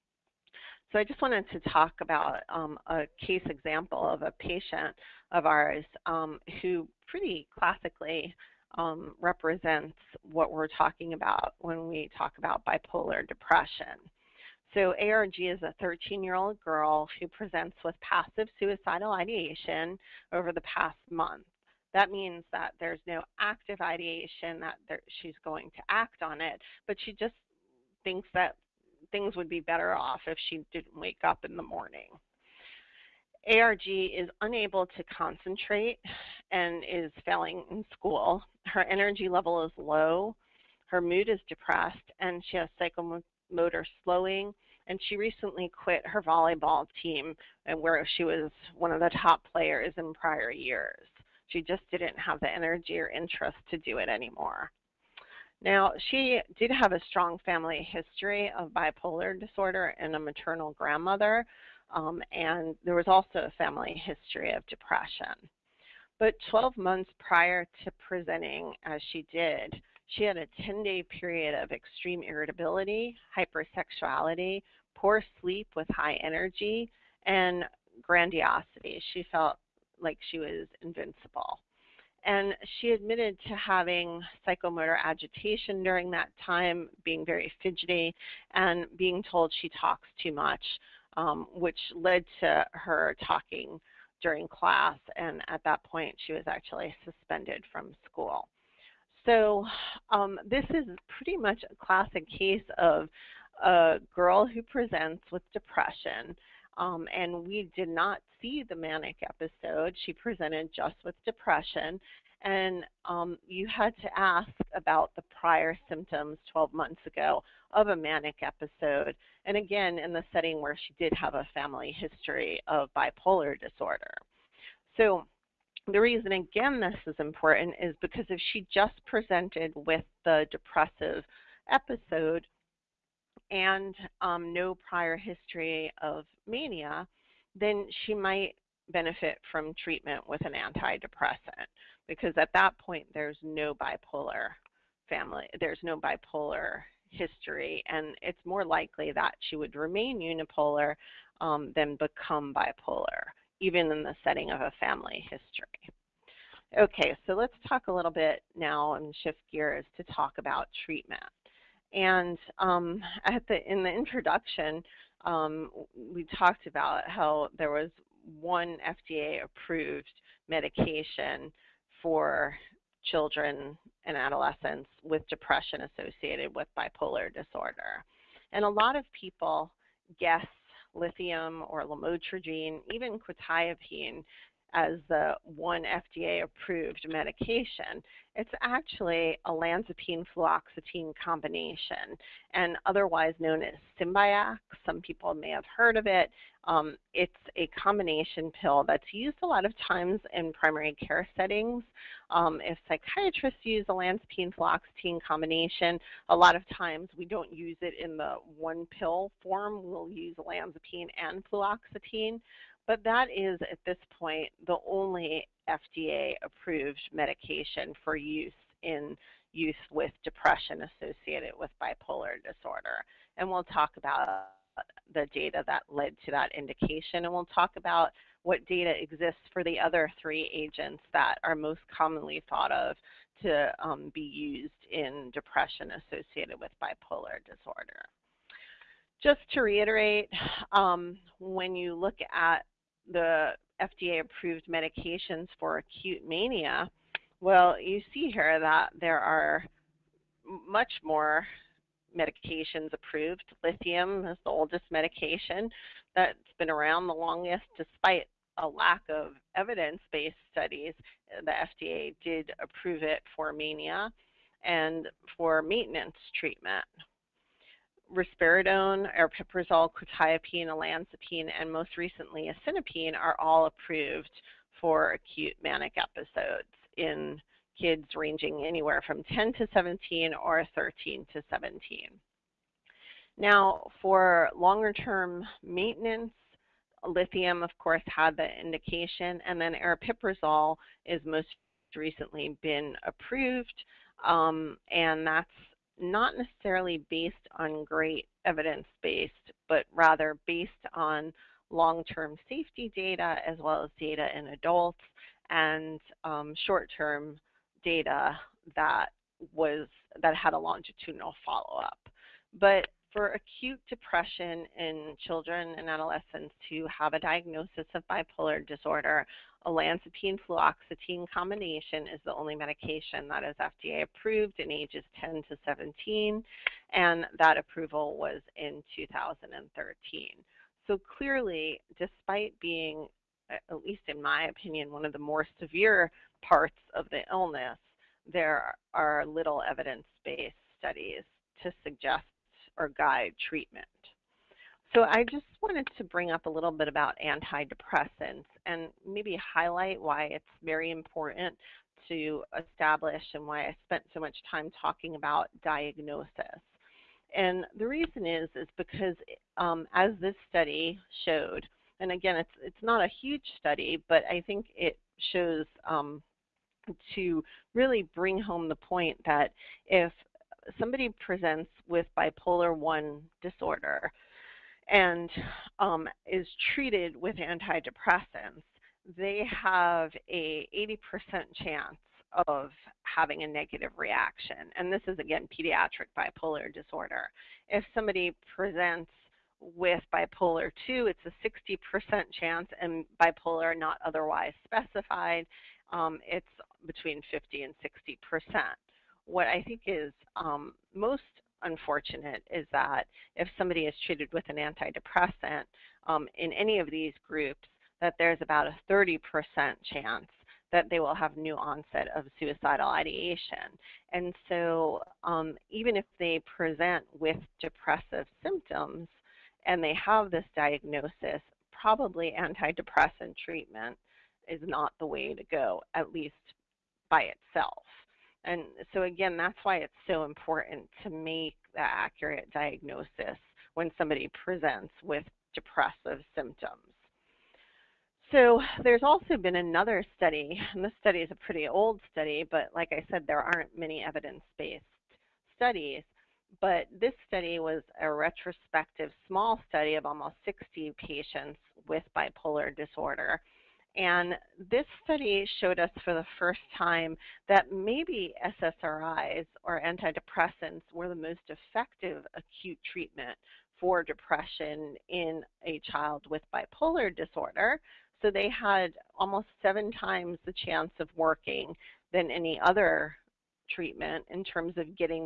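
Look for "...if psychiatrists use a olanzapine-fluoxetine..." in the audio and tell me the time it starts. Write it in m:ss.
3:22.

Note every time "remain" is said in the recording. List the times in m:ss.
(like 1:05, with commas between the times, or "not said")
2:29.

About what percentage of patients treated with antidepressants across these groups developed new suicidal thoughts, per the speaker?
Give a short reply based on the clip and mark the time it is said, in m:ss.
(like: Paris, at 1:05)
30%, at 6:48.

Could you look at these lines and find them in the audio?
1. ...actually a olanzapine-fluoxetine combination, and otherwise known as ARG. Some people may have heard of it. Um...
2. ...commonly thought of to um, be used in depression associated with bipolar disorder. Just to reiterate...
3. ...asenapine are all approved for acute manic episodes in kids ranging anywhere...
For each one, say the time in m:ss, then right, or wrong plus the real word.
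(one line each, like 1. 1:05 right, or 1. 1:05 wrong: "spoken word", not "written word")
1. 3:08 wrong: "Symbyax", not "ARG"
2. 3:51 right
3. 4:32 right.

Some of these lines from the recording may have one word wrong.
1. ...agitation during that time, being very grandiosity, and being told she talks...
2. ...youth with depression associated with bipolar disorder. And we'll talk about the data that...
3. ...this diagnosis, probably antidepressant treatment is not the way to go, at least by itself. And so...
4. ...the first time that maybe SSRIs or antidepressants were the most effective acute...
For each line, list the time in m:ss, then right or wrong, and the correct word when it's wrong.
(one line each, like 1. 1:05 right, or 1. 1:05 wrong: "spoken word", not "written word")
1. 1:25 wrong: "fidgety", not "grandiosity"
2. 3:39 right
3. 7:00 right
4. 7:36 right.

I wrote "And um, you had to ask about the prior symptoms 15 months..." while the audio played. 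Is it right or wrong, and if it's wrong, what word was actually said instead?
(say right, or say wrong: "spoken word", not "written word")
wrong: "12", not "15".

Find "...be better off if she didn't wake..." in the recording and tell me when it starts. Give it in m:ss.
0:29.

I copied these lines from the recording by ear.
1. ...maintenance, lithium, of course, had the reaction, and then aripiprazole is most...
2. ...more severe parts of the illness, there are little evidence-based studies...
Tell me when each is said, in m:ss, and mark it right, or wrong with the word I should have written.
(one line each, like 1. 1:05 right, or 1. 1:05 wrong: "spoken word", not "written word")
1. 4:45 wrong: "indication", not "reaction"
2. 5:35 right.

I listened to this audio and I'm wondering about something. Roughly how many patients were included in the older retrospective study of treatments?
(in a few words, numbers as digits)
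almost 60.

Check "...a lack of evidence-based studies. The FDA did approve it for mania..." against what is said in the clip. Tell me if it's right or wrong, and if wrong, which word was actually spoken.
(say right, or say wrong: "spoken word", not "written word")
right.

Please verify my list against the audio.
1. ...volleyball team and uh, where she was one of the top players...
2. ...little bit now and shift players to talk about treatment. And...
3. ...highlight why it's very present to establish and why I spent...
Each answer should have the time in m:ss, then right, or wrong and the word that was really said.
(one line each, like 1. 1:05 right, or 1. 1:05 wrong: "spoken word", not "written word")
1. 0:46 right
2. 2:37 wrong: "gears", not "players"
3. 5:49 wrong: "important", not "present".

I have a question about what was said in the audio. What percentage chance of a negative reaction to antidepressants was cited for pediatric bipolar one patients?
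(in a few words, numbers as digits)
80%.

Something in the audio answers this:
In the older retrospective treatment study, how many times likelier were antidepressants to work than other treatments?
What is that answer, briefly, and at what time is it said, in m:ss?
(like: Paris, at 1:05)
7 times, at 7:49.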